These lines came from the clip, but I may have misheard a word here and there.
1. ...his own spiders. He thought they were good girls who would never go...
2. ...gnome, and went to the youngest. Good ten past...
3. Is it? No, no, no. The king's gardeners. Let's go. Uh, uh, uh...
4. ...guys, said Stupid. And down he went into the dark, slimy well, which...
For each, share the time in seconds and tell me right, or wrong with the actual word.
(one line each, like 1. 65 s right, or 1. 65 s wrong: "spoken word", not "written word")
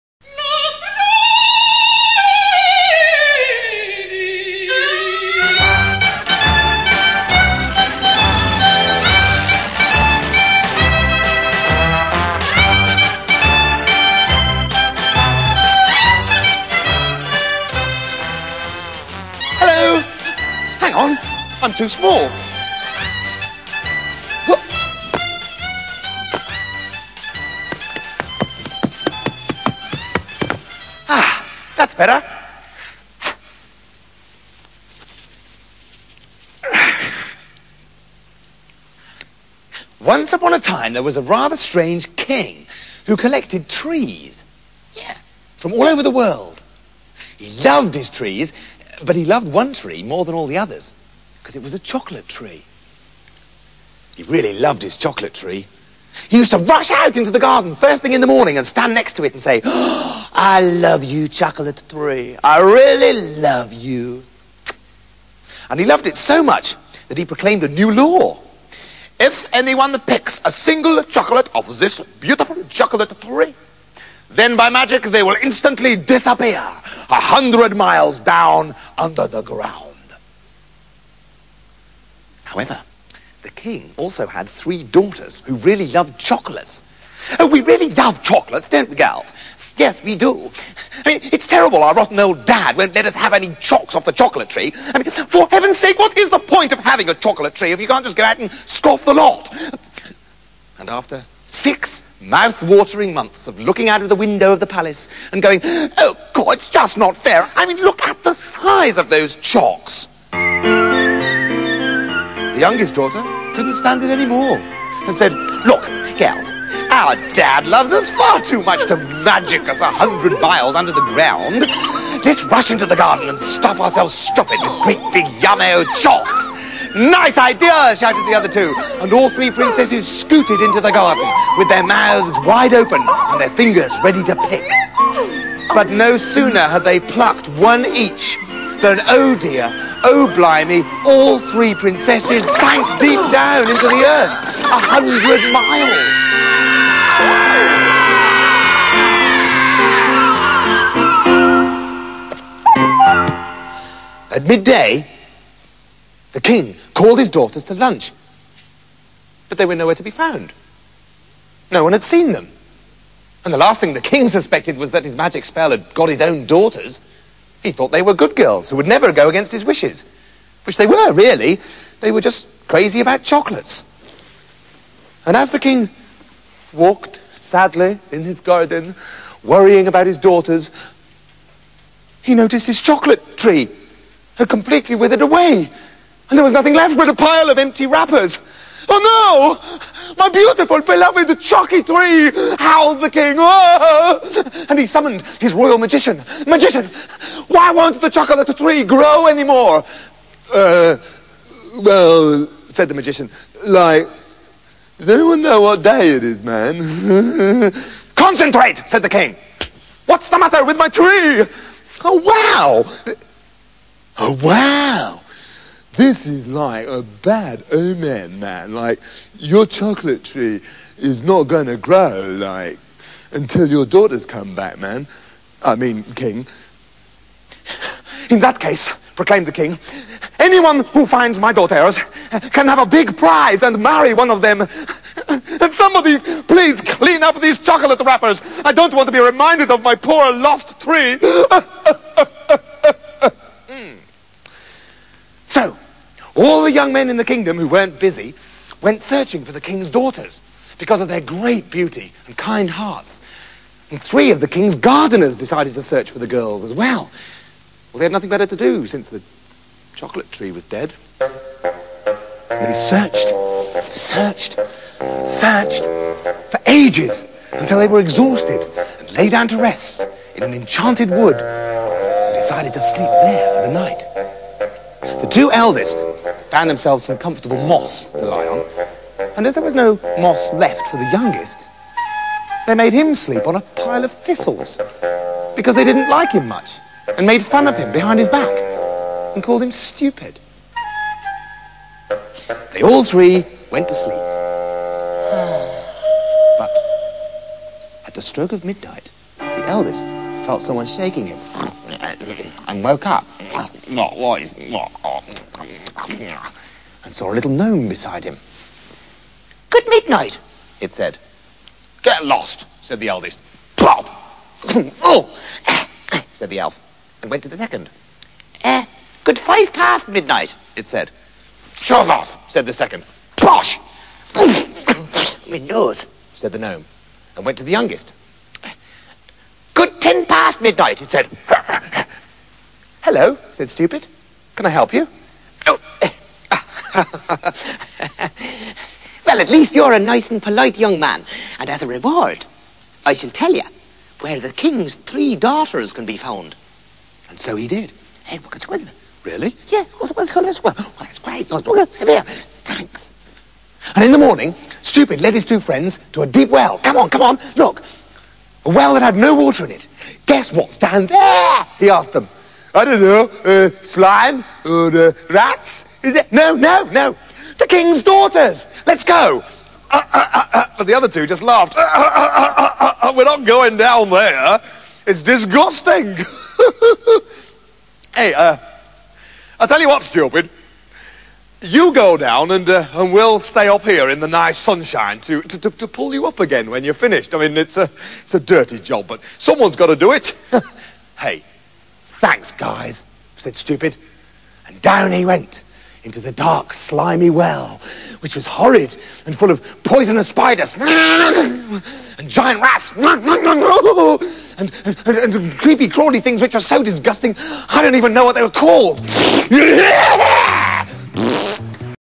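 1. 166 s wrong: "daughters", not "spiders"
2. 326 s right
3. 366 s wrong: "daughters", not "gardeners"
4. 392 s right.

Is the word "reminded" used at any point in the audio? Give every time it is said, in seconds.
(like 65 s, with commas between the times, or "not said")
239 s.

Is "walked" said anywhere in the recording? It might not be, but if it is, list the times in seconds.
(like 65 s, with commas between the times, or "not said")
176 s.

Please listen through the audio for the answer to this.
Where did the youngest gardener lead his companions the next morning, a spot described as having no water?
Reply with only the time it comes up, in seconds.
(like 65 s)
356 s.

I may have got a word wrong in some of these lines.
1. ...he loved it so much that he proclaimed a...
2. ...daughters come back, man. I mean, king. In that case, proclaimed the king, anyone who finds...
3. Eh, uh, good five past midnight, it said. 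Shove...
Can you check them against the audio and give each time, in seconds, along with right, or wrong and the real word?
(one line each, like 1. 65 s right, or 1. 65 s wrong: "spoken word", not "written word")
1. 65 s right
2. 223 s right
3. 318 s right.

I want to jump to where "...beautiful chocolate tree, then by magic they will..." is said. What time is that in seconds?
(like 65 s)
72 s.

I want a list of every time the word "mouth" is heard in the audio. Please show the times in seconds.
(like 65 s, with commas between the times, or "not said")
102 s, 131 s.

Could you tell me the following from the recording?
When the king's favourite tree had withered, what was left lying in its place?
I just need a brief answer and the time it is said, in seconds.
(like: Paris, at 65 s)
empty wrappers, at 187 s.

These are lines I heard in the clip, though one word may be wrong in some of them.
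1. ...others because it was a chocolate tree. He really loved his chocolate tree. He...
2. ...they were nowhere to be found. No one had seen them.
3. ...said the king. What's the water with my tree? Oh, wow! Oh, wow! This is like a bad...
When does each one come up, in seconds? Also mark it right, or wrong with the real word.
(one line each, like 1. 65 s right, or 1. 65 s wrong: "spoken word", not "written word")
1. 50 s right
2. 159 s right
3. 208 s wrong: "matter", not "water".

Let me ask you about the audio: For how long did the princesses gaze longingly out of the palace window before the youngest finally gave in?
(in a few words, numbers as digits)
6 months.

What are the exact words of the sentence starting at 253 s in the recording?
And three of the king's gardeners decided to search for the girls as well.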